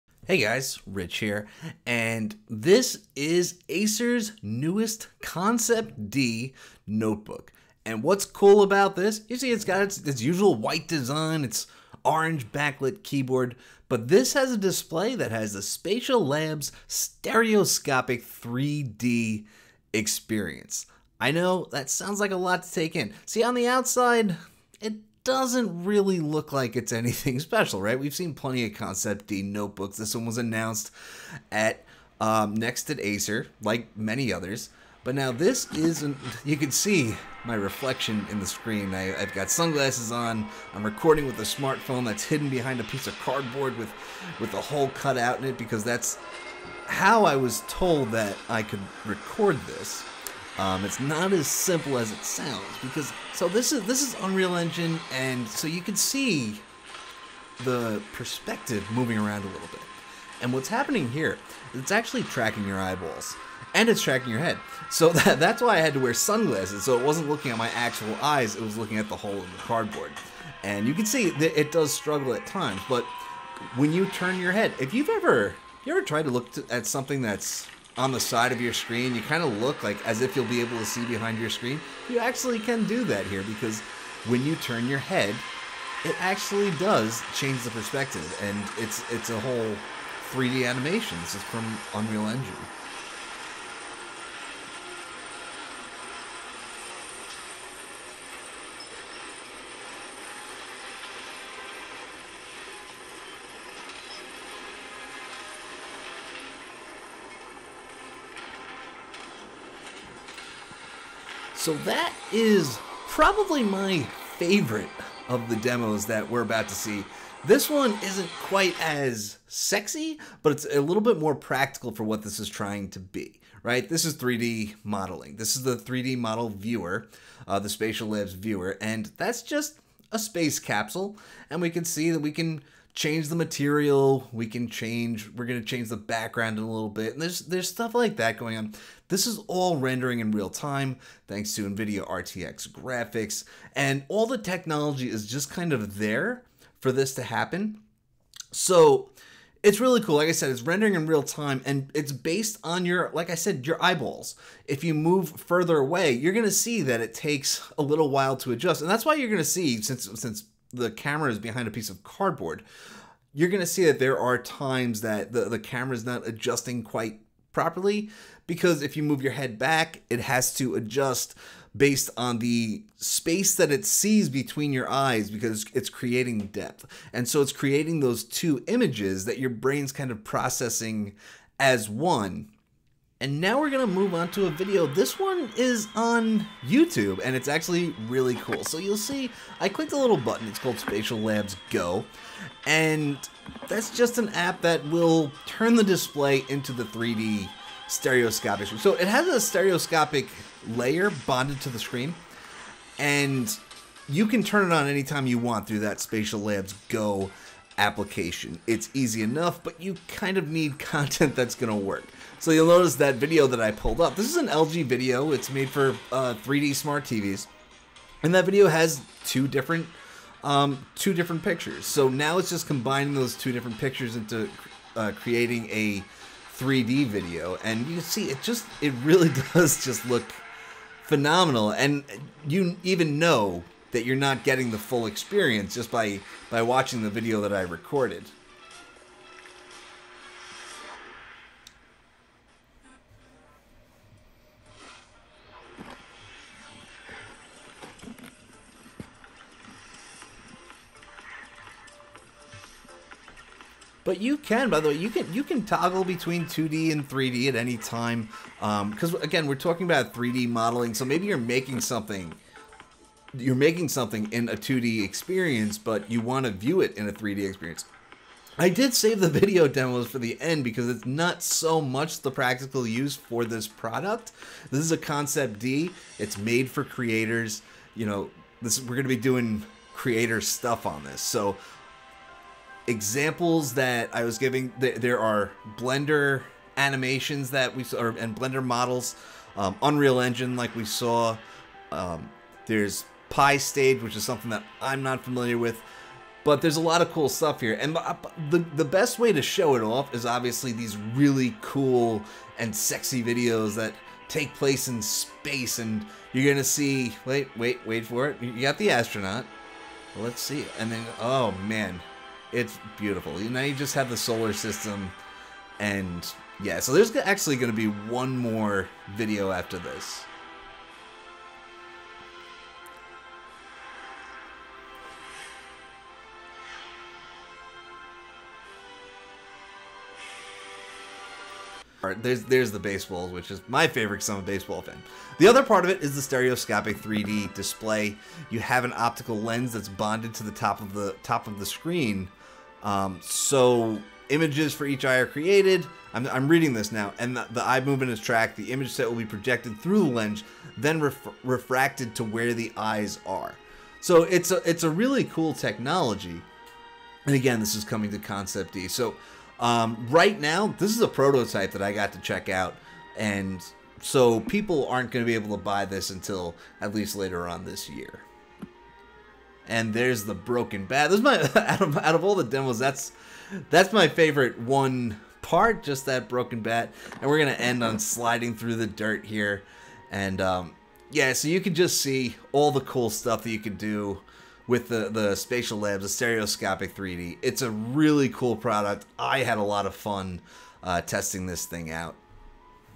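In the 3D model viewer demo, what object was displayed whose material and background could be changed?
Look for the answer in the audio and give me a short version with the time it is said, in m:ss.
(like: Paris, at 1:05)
A space capsule, at 2:10.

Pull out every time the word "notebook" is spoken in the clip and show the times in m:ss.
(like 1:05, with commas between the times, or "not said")
0:06, 0:29.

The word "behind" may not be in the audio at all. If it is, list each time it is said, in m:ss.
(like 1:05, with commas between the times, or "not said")
0:42, 1:21, 2:41.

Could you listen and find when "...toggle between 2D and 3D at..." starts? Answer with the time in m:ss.
4:15.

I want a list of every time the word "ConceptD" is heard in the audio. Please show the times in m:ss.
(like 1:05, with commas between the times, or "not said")
0:05, 0:28, 4:34, 5:58.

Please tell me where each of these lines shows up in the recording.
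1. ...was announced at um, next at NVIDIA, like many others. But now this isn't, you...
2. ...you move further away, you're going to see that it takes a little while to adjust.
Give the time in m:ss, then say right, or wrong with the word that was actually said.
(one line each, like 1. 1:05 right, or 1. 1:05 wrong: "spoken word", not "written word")
1. 0:30 wrong: "Acer", not "NVIDIA"
2. 2:34 right.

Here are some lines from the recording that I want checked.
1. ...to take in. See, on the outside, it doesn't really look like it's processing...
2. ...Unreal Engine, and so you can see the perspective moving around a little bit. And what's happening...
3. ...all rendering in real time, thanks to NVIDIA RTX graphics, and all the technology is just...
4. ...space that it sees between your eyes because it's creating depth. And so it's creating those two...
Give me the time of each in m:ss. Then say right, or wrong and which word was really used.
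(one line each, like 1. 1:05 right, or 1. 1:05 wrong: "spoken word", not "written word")
1. 0:22 wrong: "anything", not "processing"
2. 0:54 right
3. 2:19 right
4. 2:52 right.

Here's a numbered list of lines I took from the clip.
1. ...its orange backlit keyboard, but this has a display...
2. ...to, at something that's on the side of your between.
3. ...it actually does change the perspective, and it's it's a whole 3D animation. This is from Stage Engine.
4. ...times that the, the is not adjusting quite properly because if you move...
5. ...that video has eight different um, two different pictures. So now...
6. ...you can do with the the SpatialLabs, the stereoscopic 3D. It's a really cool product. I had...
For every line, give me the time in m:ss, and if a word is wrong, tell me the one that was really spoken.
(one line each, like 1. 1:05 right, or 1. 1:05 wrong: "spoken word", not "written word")
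1. 0:11 right
2. 1:16 wrong: "screen", not "between"
3. 1:26 wrong: "Unreal", not "Stage"
4. 2:44 right
5. 3:38 wrong: "two", not "eight"
6. 6:23 right.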